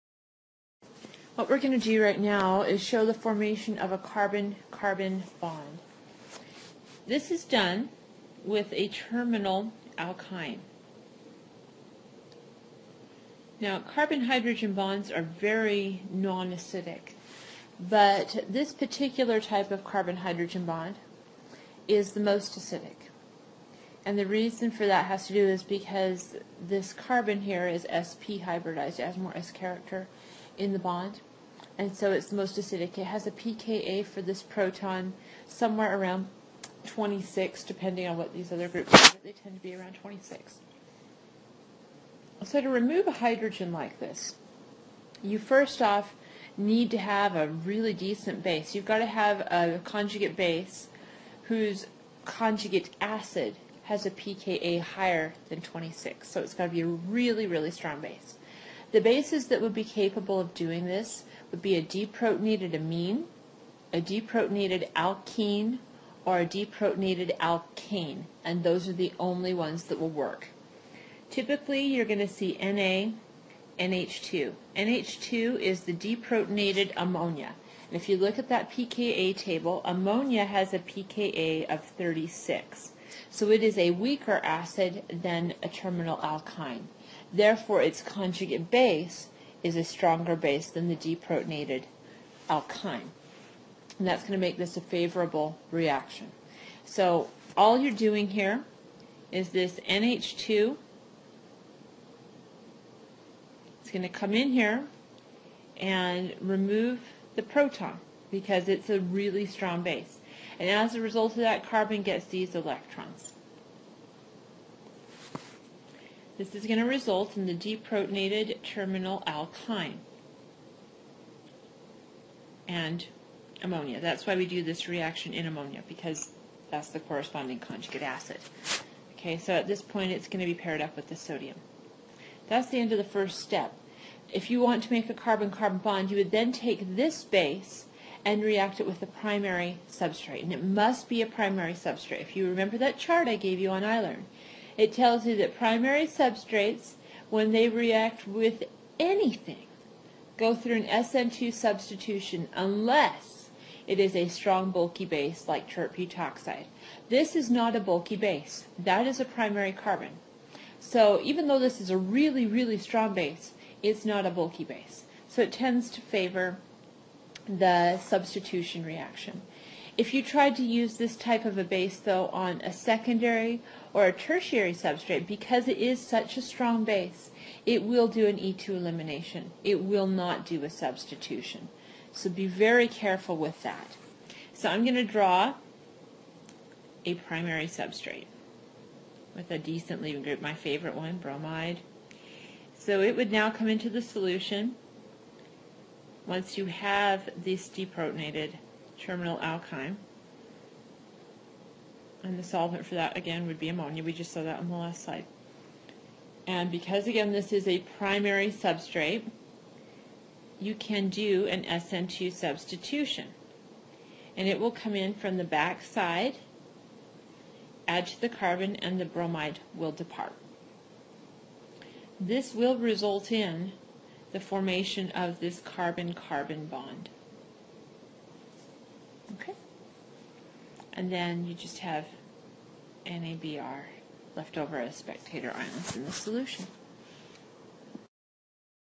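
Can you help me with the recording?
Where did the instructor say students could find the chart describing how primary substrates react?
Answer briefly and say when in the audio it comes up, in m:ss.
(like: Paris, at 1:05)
iLearn, at 2:23.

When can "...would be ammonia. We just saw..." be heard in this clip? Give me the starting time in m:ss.
3:23.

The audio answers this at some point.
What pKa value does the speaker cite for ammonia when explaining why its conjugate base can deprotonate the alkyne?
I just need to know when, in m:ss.
1:20.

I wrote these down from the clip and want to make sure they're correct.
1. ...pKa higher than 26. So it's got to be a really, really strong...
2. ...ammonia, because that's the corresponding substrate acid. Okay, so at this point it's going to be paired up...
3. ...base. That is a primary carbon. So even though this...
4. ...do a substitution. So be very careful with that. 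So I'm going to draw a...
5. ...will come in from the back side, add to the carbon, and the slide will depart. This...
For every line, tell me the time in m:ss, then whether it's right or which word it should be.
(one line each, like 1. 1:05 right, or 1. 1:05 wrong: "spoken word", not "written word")
1. 0:54 right
2. 2:05 wrong: "conjugate", not "substrate"
3. 2:38 right
4. 3:00 right
5. 3:34 wrong: "bromide", not "slide".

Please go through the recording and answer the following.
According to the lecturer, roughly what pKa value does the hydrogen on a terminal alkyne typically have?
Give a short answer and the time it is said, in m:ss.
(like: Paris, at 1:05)
26, at 0:35.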